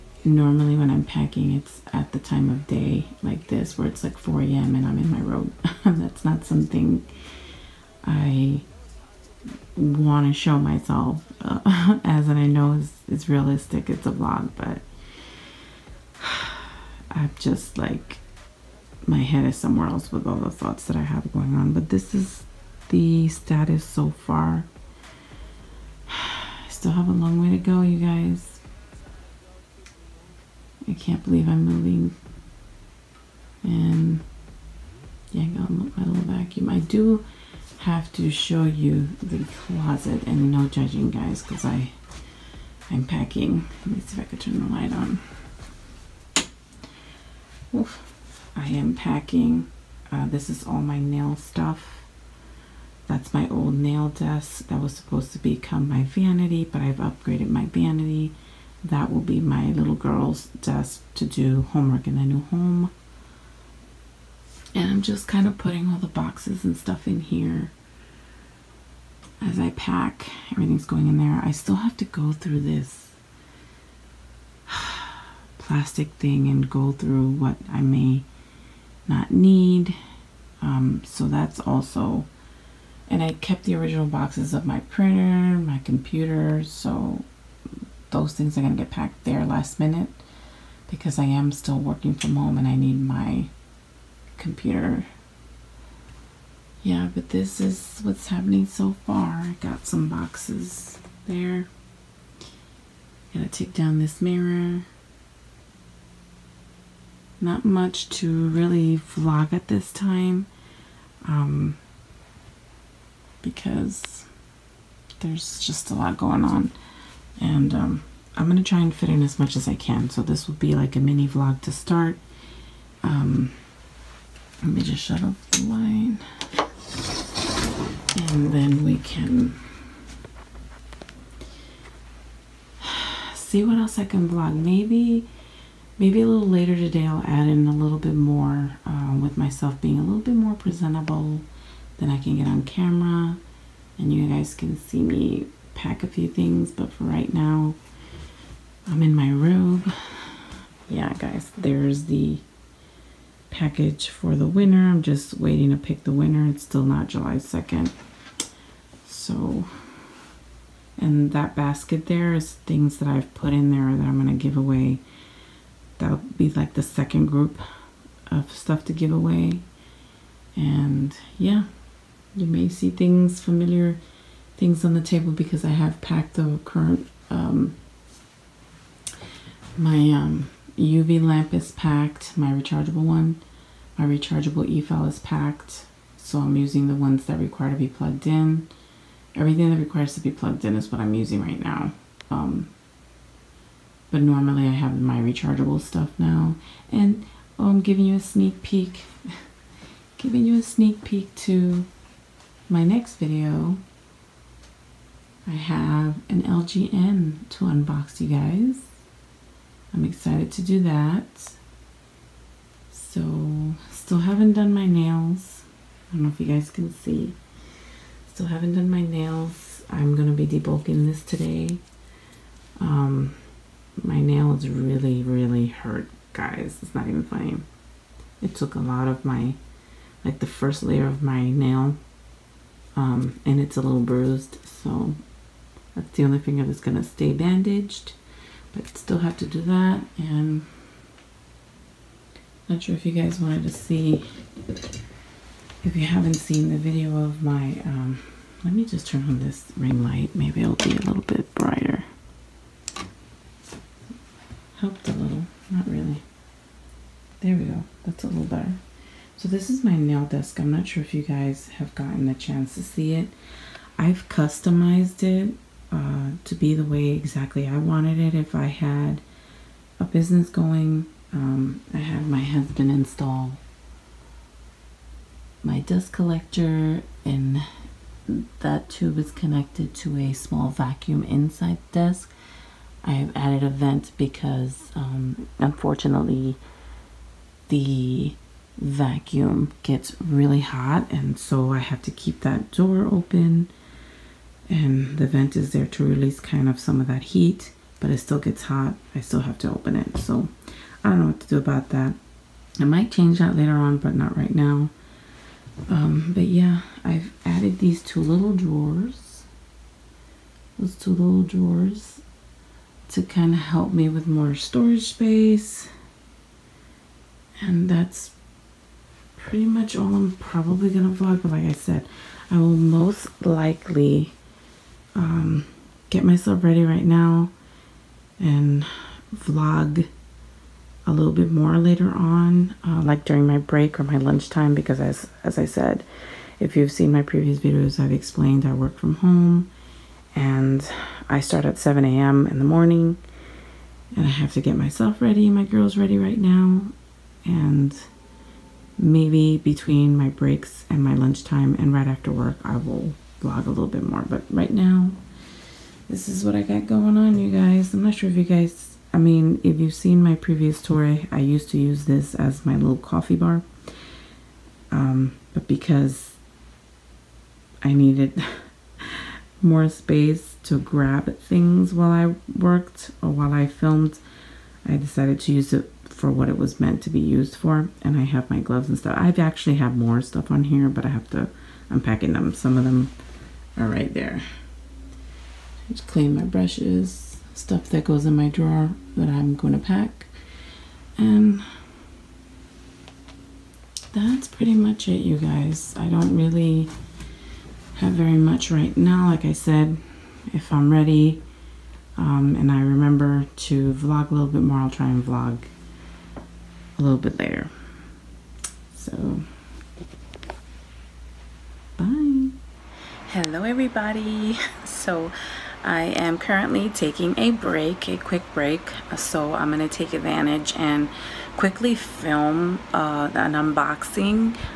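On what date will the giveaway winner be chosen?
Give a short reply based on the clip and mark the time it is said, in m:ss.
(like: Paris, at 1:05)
July 2nd, at 2:37.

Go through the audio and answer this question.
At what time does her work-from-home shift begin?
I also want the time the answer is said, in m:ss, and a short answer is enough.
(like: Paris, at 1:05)
7 a.m., at 5:41.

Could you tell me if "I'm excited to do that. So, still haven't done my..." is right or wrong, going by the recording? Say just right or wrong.
right.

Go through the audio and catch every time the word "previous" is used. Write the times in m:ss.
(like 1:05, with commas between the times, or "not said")
5:37, 6:00.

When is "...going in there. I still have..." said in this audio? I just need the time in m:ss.
1:10.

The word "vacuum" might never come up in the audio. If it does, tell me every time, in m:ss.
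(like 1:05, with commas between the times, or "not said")
0:36, 4:40, 4:48.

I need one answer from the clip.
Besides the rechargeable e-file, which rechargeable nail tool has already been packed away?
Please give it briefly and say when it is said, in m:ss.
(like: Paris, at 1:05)
UV lamp, at 3:00.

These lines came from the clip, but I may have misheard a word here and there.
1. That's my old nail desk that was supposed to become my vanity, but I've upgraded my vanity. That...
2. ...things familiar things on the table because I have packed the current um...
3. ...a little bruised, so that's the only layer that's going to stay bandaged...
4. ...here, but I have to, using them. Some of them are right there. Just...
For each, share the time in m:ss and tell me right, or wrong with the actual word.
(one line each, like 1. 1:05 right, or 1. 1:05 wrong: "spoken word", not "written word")
1. 0:53 right
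2. 2:52 right
3. 3:53 wrong: "finger", not "layer"
4. 6:20 wrong: "unpacking", not "using".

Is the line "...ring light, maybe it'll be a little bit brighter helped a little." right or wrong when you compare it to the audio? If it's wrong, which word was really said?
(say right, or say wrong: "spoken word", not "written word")
right.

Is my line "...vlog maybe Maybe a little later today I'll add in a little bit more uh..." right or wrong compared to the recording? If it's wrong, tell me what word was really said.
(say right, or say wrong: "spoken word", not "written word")
right.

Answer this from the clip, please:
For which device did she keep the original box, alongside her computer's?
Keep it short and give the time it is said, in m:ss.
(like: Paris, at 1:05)
printer, at 1:24.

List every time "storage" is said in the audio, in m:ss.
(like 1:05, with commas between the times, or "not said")
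5:14.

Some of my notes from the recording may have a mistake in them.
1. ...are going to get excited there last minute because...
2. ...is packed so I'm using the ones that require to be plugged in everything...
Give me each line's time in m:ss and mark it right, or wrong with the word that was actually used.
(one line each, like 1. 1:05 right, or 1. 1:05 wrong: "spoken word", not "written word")
1. 1:28 wrong: "packed", not "excited"
2. 3:05 right.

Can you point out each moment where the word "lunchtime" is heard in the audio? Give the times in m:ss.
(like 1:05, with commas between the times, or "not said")
5:34, 5:51.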